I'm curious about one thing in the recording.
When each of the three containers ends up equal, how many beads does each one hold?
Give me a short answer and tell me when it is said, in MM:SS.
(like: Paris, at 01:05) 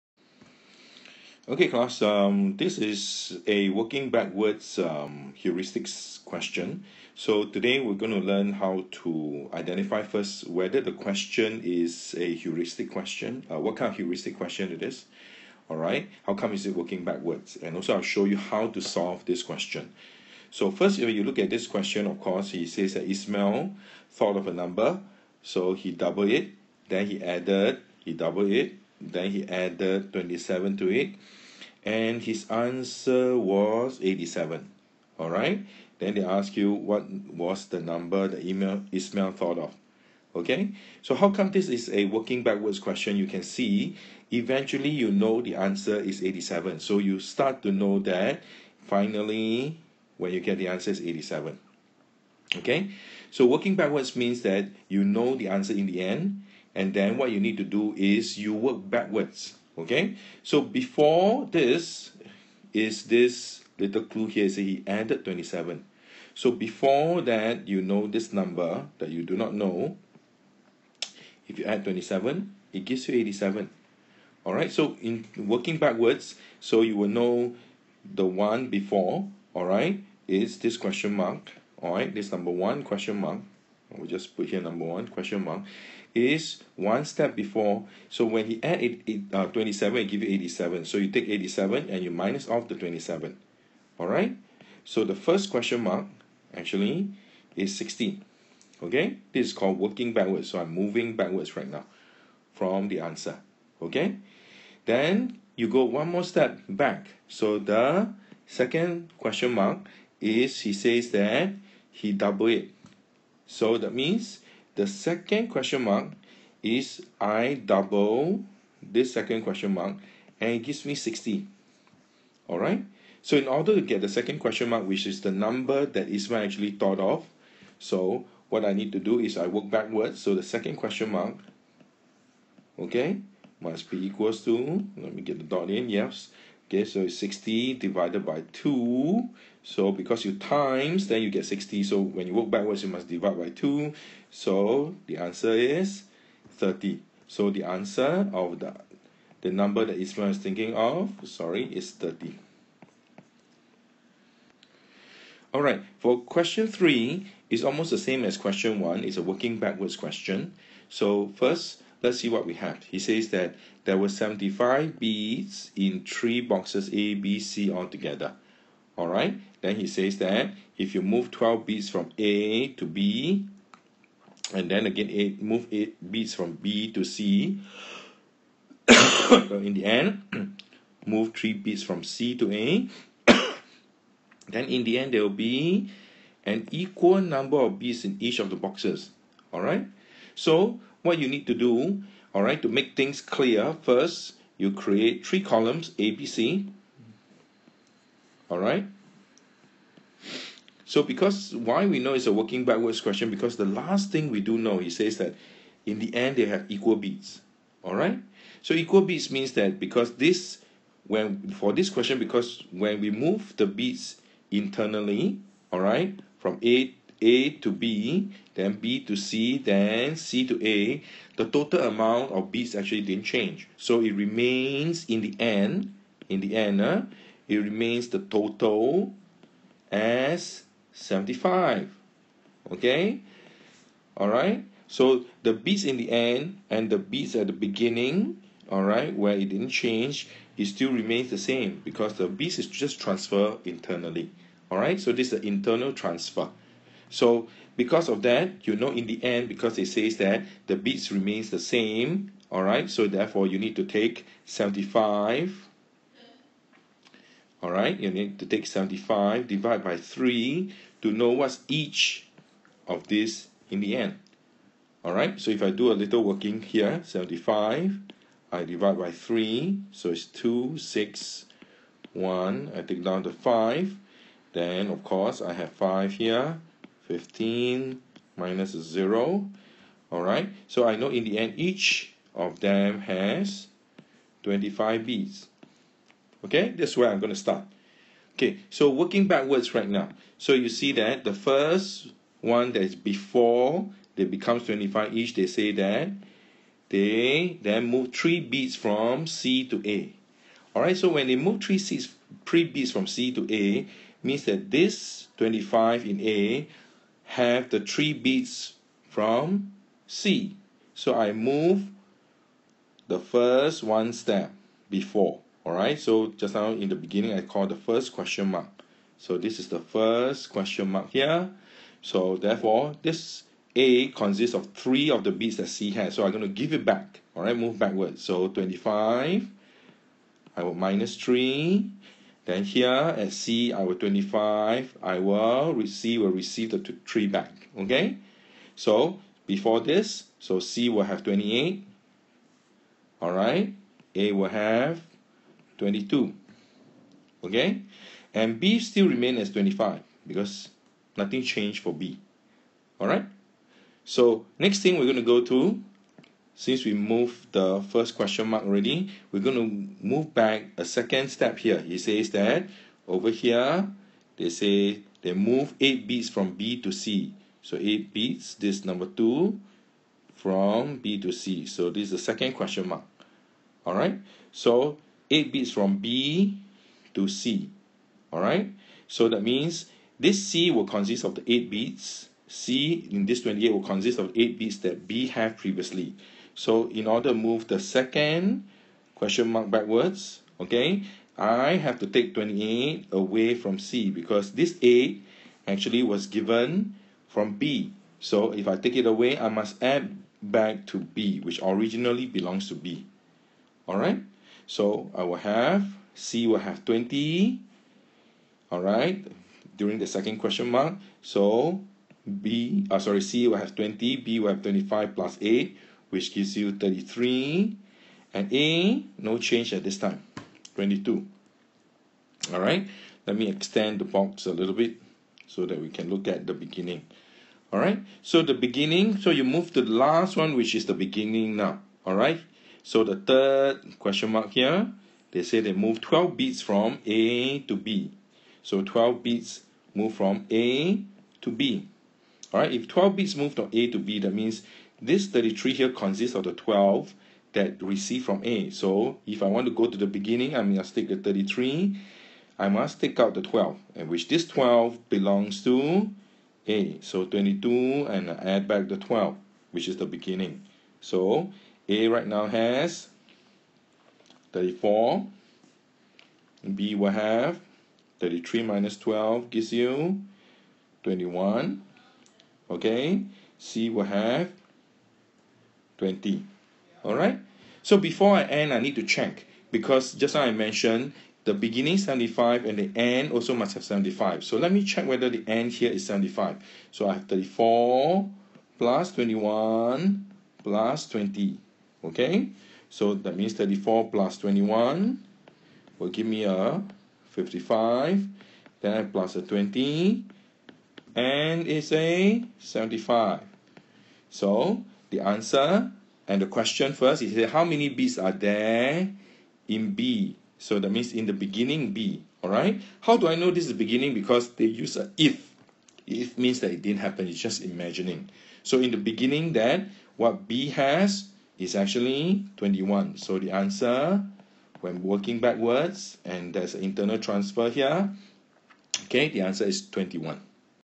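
25, at 04:41.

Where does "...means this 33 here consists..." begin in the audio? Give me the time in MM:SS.
07:24.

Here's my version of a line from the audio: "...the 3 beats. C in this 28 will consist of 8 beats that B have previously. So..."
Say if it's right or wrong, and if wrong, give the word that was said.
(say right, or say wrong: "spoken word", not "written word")
wrong: "8", not "3".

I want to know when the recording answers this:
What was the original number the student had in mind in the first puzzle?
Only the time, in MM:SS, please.
02:24.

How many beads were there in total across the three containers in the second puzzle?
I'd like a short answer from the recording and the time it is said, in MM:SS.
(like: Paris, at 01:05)
75 beads, at 02:43.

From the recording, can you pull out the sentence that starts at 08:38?
So in the beginning, then what B has is actually 21.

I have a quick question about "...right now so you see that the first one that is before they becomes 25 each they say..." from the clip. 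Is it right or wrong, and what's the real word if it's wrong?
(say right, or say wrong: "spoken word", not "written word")
right.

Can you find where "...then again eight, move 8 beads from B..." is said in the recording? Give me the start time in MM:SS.
02:54.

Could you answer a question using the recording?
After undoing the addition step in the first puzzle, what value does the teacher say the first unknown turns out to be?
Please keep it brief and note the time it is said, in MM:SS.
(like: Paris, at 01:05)
16, at 01:35.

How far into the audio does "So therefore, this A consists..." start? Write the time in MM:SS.
05:22.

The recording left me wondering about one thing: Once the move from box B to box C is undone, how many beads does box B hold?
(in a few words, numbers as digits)
33.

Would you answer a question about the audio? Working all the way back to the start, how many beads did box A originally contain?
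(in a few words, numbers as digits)
34.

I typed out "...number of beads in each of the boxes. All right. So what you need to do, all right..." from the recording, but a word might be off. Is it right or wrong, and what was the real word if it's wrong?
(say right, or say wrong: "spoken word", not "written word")
right.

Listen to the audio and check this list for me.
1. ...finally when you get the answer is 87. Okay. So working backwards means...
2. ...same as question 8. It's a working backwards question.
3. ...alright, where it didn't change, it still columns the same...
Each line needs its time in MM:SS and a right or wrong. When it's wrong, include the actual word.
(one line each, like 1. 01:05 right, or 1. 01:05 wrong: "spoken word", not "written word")
1. 00:48 right
2. 02:37 wrong: "1", not "8"
3. 03:58 wrong: "remains", not "columns".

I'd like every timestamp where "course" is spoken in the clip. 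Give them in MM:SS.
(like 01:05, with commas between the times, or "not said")
00:22, 04:35.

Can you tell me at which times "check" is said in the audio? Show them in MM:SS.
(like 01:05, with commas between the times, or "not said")
07:59, 08:04.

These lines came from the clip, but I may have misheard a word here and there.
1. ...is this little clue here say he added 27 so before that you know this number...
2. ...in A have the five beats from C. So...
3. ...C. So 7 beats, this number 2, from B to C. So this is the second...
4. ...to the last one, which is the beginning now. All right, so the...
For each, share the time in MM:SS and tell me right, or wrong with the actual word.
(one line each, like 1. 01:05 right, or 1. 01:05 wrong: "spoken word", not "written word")
1. 01:02 right
2. 05:06 wrong: "three", not "five"
3. 06:06 wrong: "8", not "7"
4. 07:09 right.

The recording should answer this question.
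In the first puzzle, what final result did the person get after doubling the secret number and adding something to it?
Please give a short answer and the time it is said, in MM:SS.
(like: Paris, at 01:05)
87, at 00:31.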